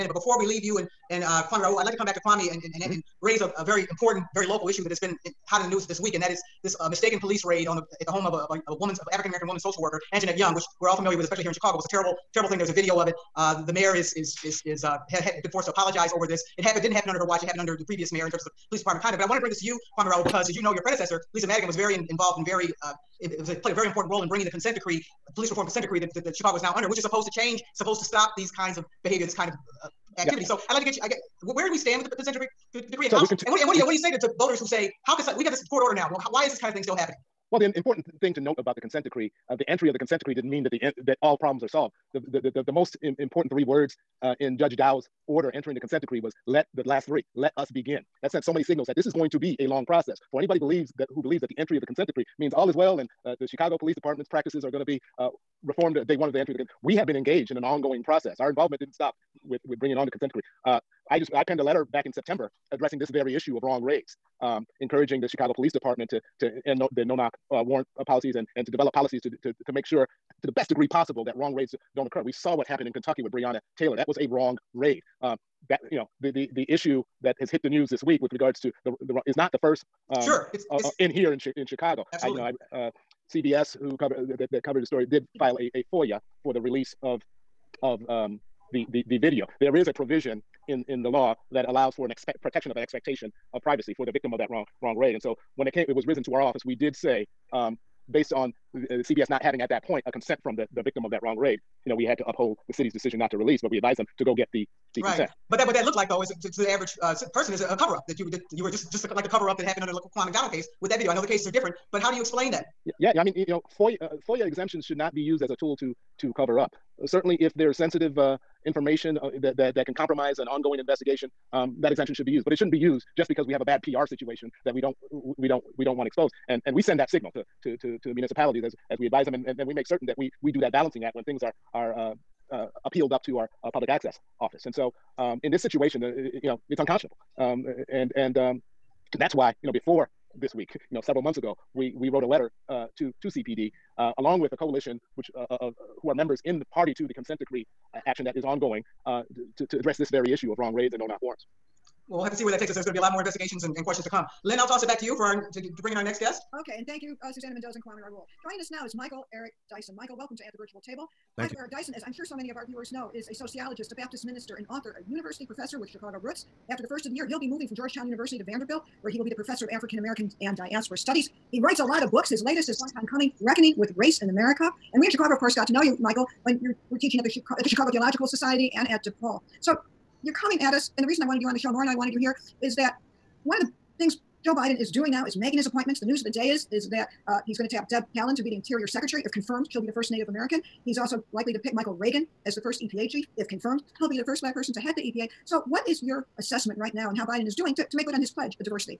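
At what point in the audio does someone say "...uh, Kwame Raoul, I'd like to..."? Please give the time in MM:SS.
00:01.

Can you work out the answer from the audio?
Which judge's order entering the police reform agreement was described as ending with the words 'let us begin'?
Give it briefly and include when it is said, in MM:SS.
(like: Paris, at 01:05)
Judge Dow, at 00:44.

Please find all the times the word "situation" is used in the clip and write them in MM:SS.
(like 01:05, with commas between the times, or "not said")
02:04, 02:15.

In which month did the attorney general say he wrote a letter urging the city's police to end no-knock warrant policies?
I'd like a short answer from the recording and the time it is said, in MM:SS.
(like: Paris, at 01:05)
September, at 01:02.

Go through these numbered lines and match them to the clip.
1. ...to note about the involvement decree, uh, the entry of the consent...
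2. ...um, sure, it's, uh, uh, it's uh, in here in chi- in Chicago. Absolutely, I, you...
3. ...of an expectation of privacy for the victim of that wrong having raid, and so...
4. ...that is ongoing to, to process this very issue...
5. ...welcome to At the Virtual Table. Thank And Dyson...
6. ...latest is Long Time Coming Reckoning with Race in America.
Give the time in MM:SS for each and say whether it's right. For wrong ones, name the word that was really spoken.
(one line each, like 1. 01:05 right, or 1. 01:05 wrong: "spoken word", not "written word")
1. 00:38 wrong: "consent", not "involvement"
2. 01:20 right
3. 01:32 wrong: "wrong", not "having"
4. 02:28 wrong: "address", not "process"
5. 02:40 wrong: "Michael", not "And"
6. 02:52 right.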